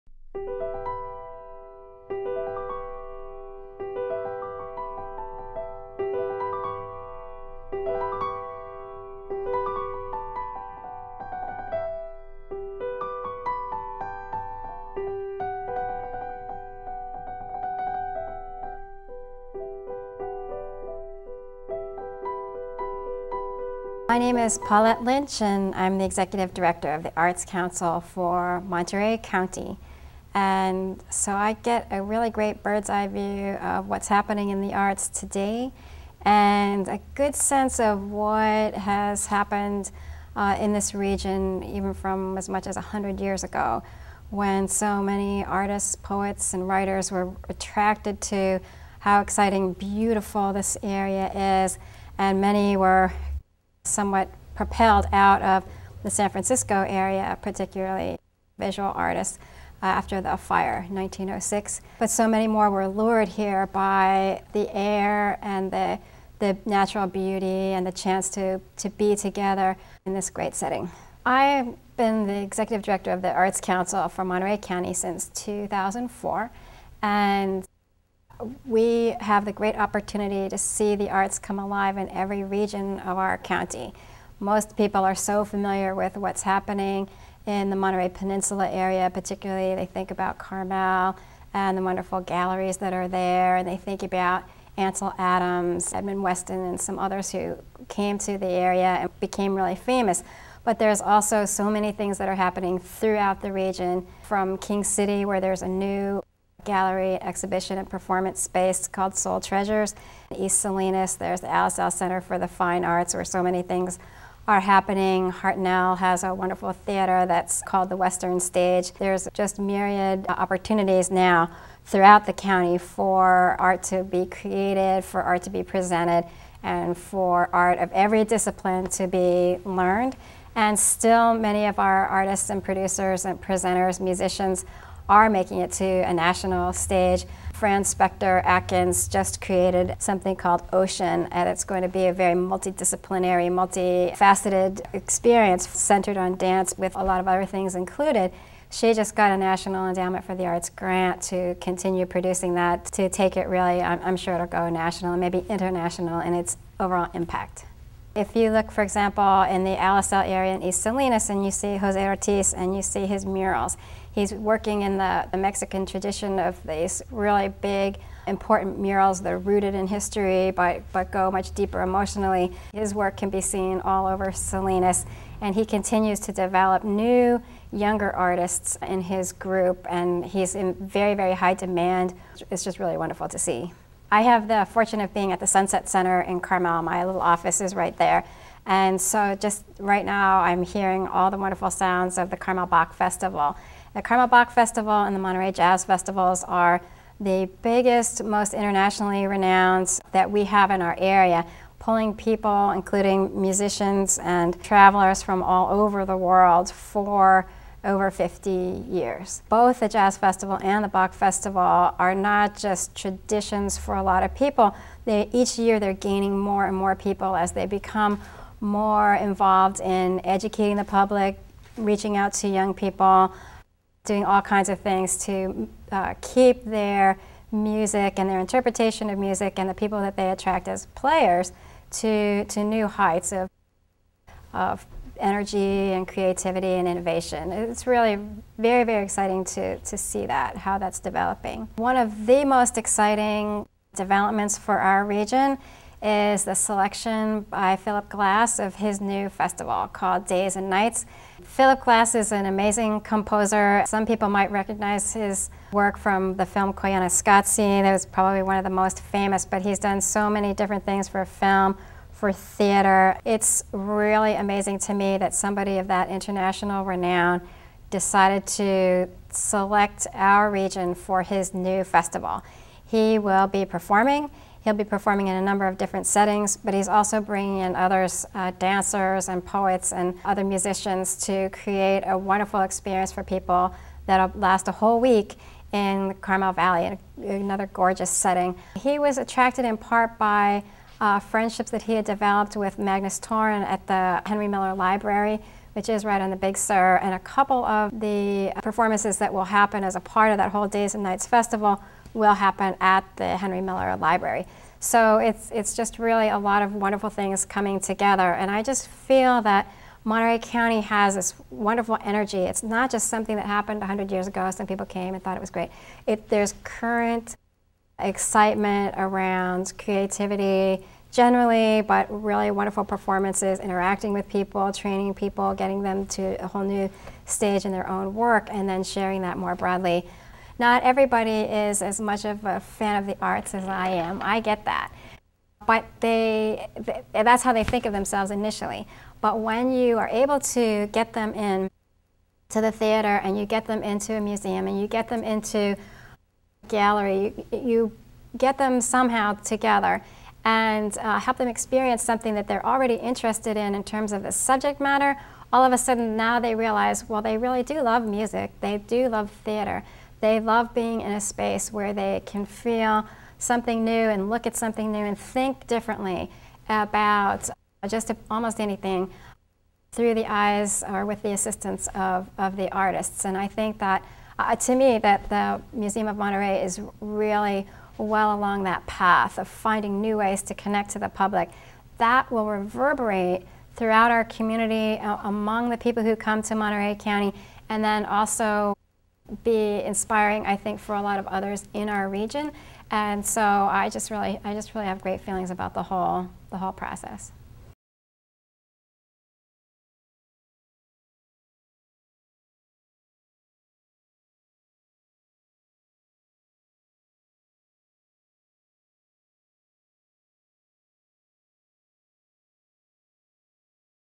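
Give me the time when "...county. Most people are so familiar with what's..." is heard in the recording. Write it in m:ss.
1:23.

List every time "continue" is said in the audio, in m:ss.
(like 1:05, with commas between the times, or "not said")
2:31, 2:55.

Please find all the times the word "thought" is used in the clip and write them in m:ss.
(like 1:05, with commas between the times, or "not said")
5:15.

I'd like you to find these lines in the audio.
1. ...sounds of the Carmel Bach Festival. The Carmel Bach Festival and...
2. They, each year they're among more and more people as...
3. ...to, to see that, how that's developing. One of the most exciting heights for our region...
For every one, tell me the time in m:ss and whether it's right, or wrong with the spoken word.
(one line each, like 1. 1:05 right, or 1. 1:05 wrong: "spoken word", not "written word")
1. 3:11 right
2. 3:35 wrong: "gaining", not "among"
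3. 3:59 wrong: "developments", not "heights".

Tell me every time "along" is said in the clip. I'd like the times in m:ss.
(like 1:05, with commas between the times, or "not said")
6:18.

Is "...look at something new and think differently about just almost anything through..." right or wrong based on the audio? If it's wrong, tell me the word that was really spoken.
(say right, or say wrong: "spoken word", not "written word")
right.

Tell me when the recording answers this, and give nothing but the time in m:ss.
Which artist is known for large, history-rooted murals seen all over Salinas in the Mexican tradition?
2:41.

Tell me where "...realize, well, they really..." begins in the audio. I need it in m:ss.
5:56.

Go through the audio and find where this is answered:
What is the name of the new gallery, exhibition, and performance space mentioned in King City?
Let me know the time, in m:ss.
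1:49.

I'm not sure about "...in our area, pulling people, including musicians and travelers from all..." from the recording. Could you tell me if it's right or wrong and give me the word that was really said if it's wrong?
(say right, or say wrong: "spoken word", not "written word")
right.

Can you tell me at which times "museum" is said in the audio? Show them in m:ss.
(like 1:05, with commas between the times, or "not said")
5:44, 6:15.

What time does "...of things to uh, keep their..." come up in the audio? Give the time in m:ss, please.
3:44.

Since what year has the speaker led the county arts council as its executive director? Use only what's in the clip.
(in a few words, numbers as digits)
2004.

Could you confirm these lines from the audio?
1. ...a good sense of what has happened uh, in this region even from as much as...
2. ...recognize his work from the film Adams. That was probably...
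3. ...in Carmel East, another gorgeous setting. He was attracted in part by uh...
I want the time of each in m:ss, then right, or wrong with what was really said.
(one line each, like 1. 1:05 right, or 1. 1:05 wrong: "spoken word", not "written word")
1. 0:36 right
2. 4:14 wrong: "Koyaanisqatsi", not "Adams"
3. 4:45 wrong: "Valley", not "East".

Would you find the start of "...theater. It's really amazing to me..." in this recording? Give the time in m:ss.
4:22.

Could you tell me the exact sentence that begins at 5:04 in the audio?
So it's, it's just really a lot of wonderful things coming together.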